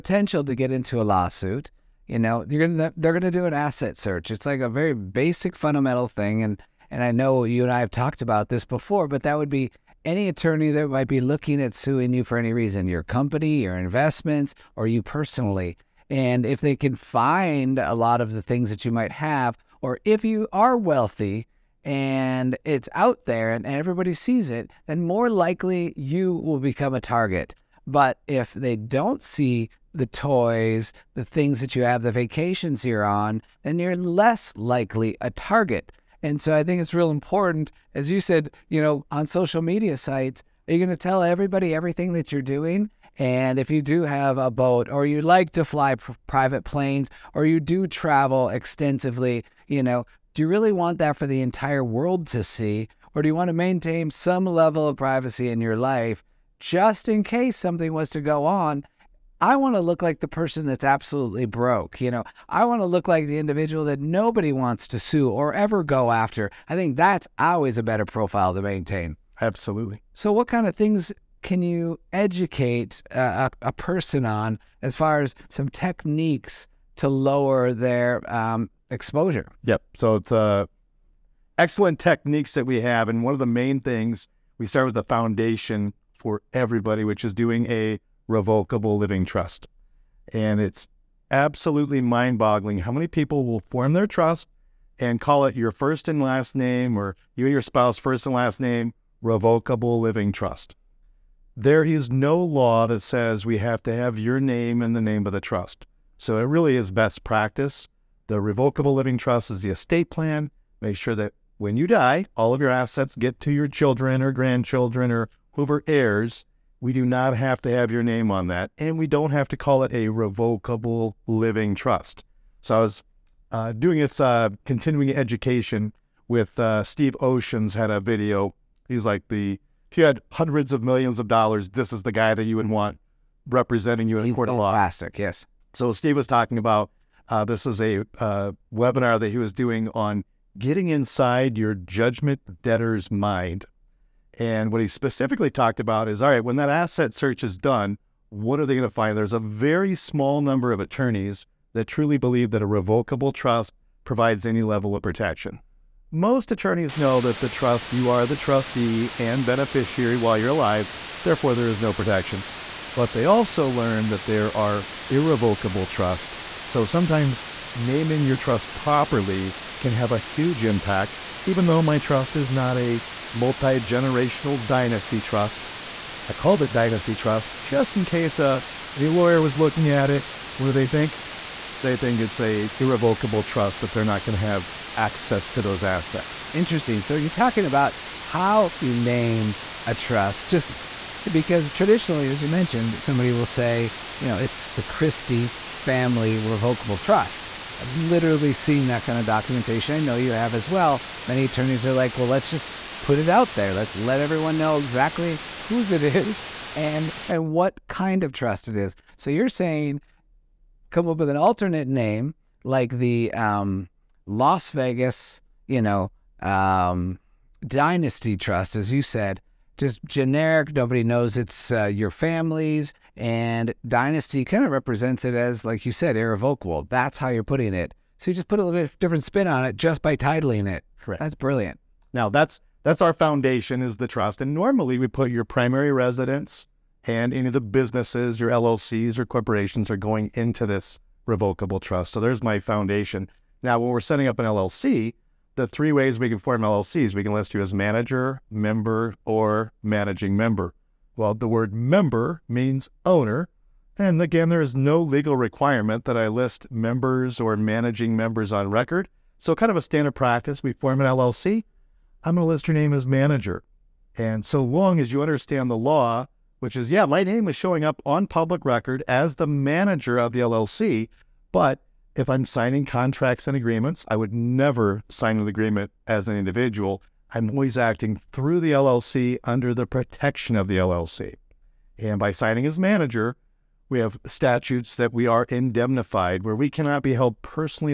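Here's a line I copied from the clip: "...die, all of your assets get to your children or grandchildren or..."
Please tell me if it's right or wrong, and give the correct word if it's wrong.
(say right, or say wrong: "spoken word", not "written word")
right.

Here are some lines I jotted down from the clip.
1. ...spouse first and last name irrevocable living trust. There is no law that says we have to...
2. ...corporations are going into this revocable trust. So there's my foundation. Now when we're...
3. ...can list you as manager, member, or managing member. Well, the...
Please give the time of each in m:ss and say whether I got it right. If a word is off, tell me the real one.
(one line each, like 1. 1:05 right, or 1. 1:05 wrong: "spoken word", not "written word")
1. 1:37 wrong: "revocable", not "irrevocable"
2. 3:59 right
3. 4:07 right.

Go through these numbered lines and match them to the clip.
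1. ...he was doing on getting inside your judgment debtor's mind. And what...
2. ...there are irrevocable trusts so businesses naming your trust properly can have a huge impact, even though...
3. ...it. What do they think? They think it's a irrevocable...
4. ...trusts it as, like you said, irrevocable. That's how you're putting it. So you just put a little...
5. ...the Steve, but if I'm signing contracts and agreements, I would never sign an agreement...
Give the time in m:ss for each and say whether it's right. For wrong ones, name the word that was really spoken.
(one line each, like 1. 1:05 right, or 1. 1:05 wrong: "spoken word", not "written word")
1. 2:19 right
2. 2:44 wrong: "sometimes", not "businesses"
3. 3:00 right
4. 3:44 wrong: "represents", not "trusts"
5. 4:30 wrong: "LLC", not "Steve".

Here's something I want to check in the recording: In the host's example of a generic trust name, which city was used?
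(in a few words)
Las Vegas.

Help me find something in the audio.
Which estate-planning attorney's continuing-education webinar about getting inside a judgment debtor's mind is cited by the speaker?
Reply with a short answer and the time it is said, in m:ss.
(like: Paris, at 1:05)
Steve Oshins, at 2:06.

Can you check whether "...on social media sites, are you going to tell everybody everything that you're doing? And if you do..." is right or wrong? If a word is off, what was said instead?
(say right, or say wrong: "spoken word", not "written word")
right.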